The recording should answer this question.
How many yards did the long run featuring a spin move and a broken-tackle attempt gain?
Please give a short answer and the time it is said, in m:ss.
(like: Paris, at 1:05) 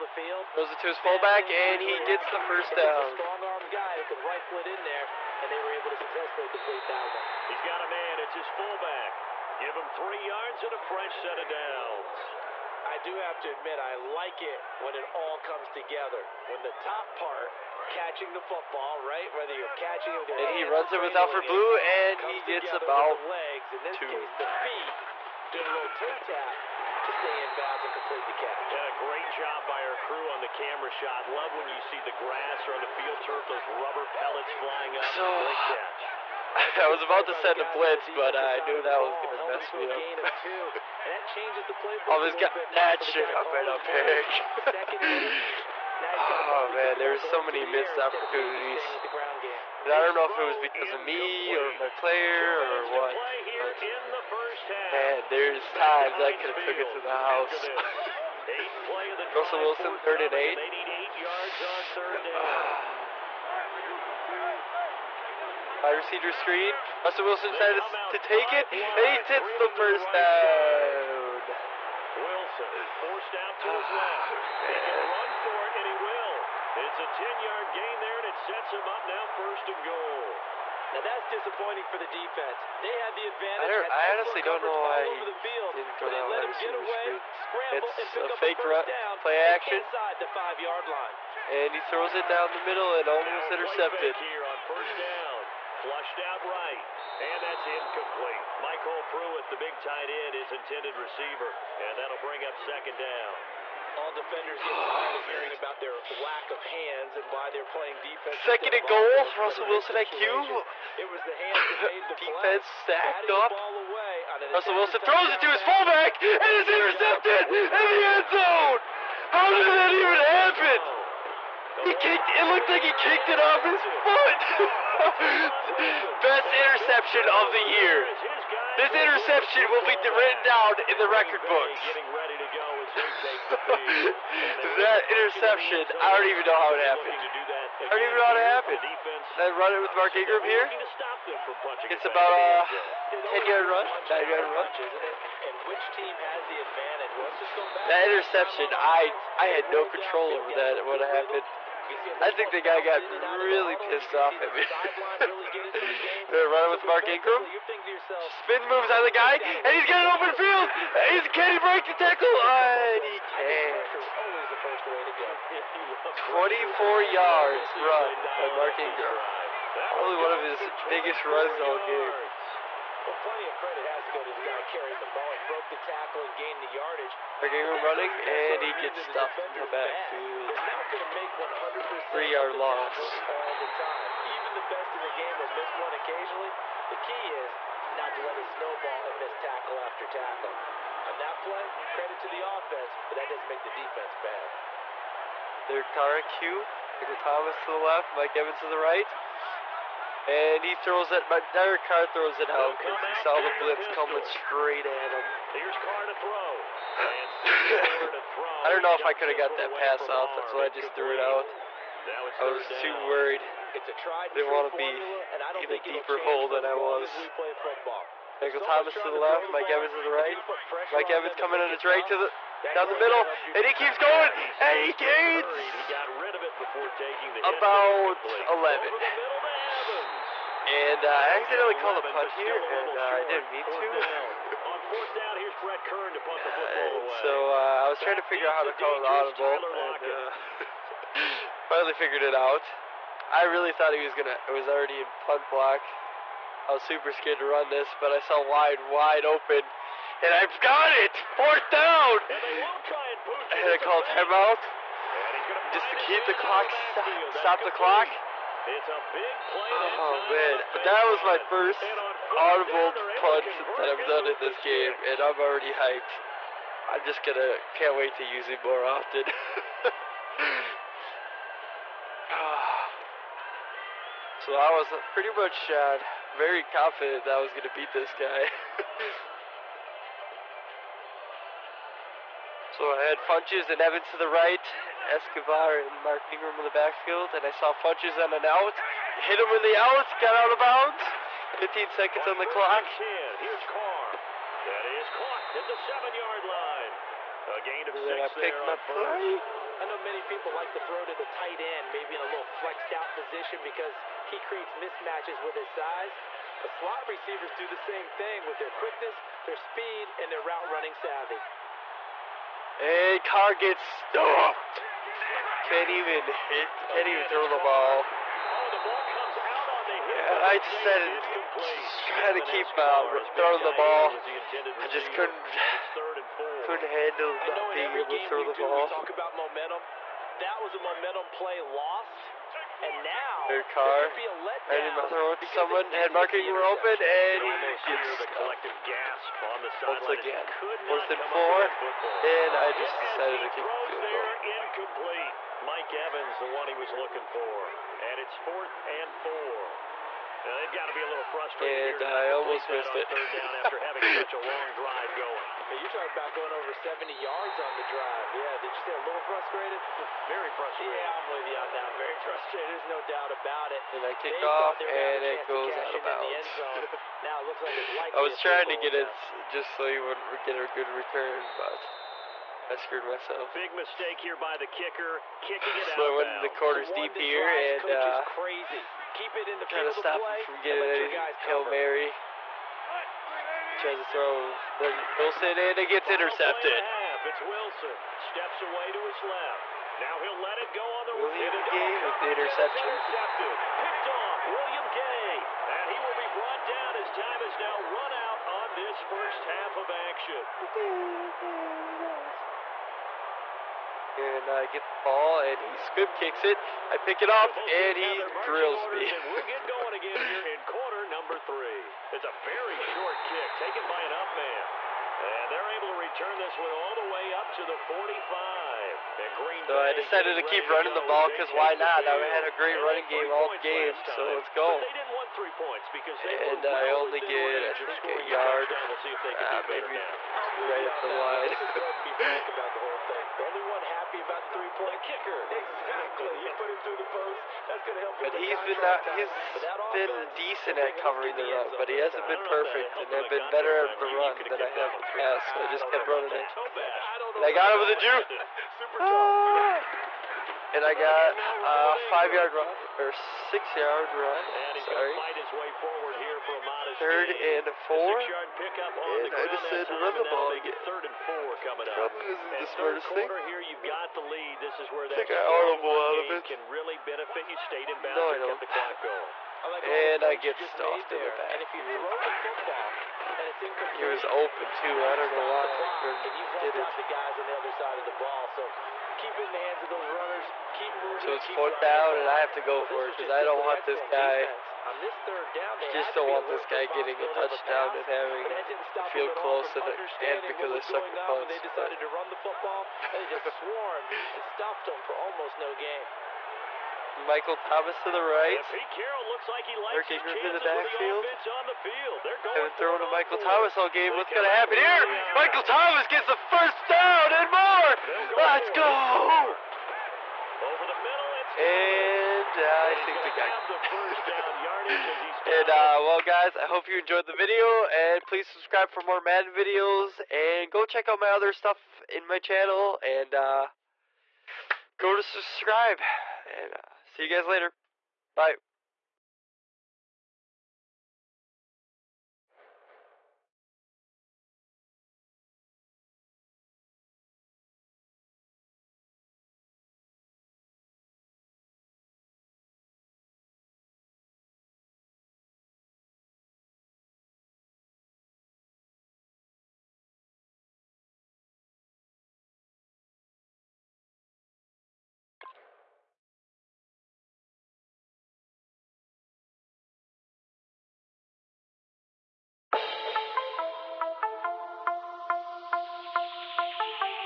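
24, at 2:46.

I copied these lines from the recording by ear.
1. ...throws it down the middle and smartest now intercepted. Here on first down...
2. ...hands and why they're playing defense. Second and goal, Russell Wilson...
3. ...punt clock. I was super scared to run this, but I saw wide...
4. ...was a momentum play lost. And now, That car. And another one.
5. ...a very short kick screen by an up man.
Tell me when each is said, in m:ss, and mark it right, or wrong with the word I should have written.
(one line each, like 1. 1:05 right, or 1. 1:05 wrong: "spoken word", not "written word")
1. 1:31 wrong: "almost", not "smartest"
2. 1:46 right
3. 4:05 wrong: "block", not "clock"
4. 5:30 wrong: "Third", not "That"
5. 6:52 wrong: "taken", not "screen".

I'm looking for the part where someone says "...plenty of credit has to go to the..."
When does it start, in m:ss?
2:53.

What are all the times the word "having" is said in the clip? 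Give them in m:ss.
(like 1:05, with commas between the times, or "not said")
5:53, 8:08.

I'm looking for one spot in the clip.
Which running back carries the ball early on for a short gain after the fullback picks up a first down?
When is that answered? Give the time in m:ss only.
0:21.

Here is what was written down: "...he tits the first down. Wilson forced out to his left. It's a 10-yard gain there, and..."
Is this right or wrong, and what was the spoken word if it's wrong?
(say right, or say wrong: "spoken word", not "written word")
right.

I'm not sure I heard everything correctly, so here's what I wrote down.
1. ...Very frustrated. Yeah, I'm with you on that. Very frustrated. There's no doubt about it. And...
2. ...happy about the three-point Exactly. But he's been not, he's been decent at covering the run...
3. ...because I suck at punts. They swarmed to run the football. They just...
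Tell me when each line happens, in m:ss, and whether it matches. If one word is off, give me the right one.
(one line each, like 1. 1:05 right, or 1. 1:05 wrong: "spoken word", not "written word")
1. 6:00 right
2. 7:13 right
3. 8:10 wrong: "decided", not "swarmed".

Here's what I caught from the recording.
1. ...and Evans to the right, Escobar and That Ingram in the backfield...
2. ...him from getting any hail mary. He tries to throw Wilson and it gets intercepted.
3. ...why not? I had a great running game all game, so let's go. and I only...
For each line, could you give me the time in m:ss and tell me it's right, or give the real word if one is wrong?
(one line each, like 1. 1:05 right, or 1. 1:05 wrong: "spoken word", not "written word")
1. 4:43 wrong: "Mark", not "That"
2. 6:20 right
3. 7:01 right.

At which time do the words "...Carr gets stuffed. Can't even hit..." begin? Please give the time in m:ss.
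5:13.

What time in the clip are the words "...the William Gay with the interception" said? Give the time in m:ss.
6:31.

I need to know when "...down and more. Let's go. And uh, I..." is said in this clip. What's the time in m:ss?
8:26.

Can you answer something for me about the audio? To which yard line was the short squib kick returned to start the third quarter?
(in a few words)
45.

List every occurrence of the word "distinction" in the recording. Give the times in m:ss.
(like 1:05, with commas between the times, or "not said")
not said.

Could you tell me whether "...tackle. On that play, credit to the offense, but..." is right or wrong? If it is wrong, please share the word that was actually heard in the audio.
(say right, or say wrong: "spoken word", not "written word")
right.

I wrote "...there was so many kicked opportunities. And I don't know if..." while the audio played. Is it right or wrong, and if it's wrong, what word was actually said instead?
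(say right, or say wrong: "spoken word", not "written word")
wrong: "missed", not "kicked".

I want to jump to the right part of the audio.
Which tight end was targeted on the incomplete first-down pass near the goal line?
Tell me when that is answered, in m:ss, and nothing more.
1:38.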